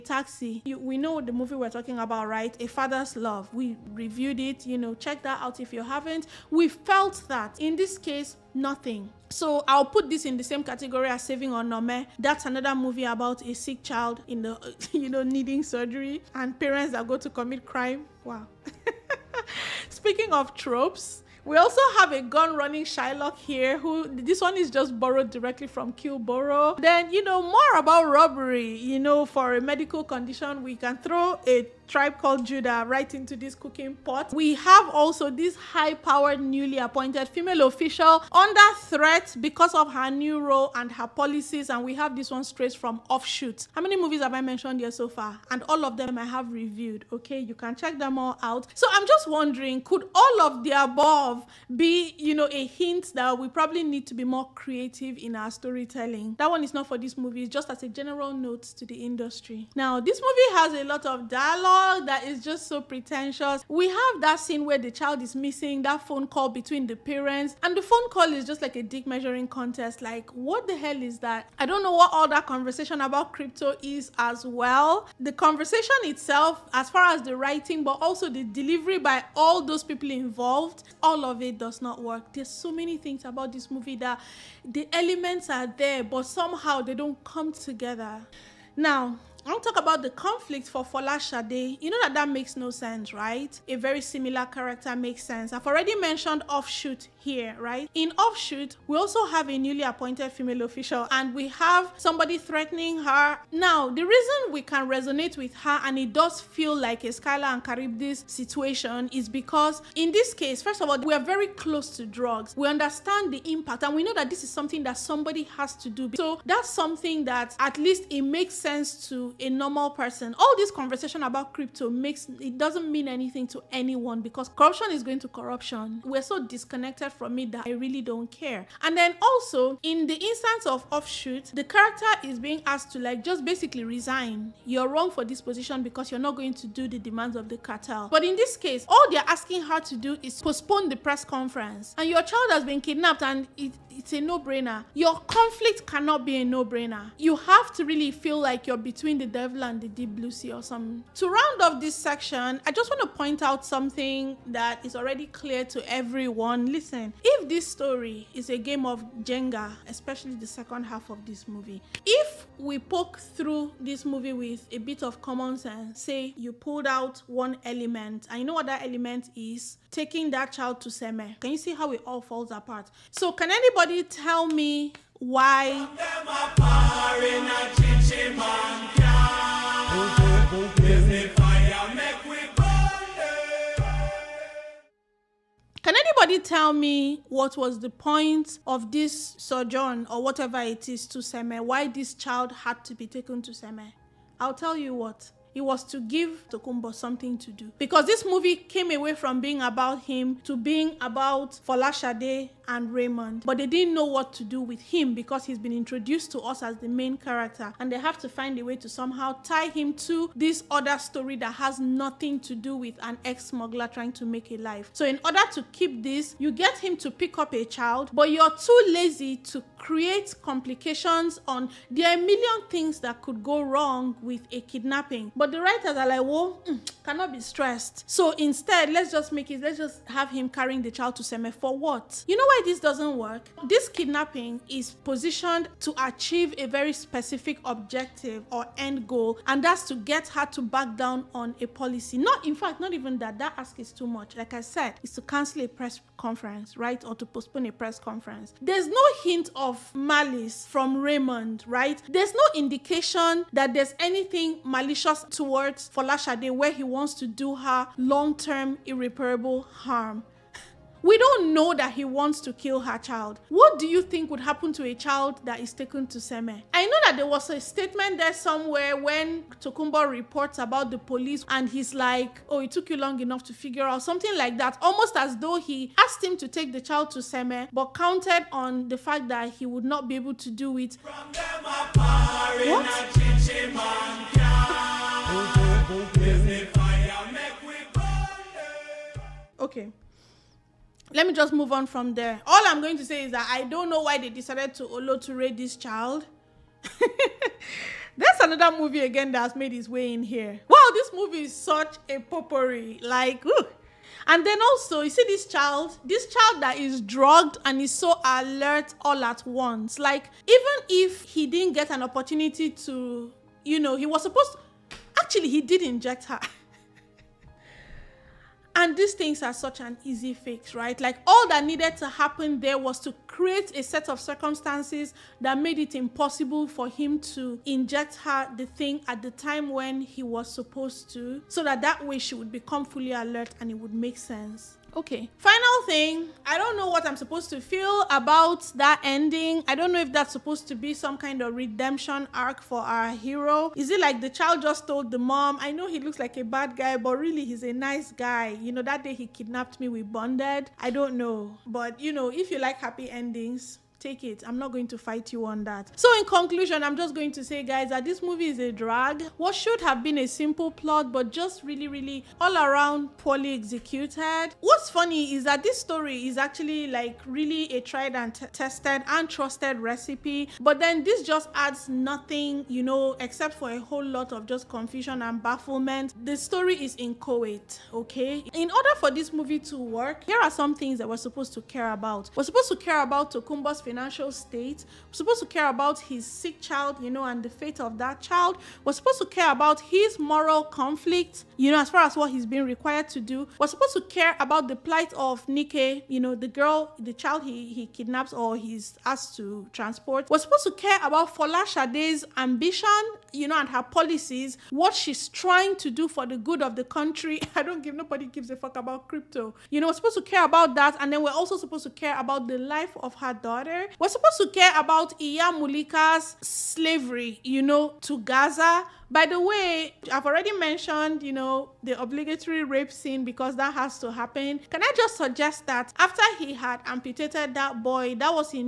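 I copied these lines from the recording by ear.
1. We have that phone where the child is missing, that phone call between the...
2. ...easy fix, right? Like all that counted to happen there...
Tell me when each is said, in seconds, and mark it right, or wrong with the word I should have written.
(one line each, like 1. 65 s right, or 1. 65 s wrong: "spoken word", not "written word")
1. 63 s wrong: "scene", not "phone"
2. 320 s wrong: "needed", not "counted".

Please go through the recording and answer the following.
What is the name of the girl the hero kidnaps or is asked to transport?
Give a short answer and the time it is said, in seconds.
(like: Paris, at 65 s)
Nike, at 395 s.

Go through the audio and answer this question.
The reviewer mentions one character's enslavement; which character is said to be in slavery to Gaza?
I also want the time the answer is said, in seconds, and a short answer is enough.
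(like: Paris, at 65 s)
Iya Mulika, at 415 s.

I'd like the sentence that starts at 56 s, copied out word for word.
That one is not for this movie, it's just as a general note to the industry.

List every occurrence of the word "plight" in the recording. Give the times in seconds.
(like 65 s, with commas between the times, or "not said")
394 s.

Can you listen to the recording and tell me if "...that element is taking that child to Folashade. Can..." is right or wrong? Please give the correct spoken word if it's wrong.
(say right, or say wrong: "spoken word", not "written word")
wrong: "Seme", not "Folashade".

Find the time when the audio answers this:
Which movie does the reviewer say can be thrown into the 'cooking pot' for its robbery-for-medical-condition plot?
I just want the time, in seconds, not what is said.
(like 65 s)
31 s.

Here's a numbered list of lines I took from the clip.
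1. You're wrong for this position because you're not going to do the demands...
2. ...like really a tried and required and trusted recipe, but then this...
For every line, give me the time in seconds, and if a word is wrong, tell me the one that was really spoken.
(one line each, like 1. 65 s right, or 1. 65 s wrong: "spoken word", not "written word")
1. 134 s right
2. 366 s wrong: "tested", not "required".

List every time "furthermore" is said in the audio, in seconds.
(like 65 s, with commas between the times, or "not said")
not said.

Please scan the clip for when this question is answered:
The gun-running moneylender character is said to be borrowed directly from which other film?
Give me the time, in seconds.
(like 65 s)
25 s.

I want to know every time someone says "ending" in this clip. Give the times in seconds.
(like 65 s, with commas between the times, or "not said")
339 s, 353 s.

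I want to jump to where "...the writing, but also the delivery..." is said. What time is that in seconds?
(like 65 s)
77 s.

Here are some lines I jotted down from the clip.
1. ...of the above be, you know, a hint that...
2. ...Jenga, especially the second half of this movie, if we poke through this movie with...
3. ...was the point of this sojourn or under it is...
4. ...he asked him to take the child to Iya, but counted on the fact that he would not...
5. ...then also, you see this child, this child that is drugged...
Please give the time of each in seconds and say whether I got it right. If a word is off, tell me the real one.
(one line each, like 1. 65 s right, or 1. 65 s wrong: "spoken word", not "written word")
1. 50 s right
2. 159 s right
3. 187 s wrong: "whatever", not "under"
4. 275 s wrong: "Seme", not "Iya"
5. 304 s right.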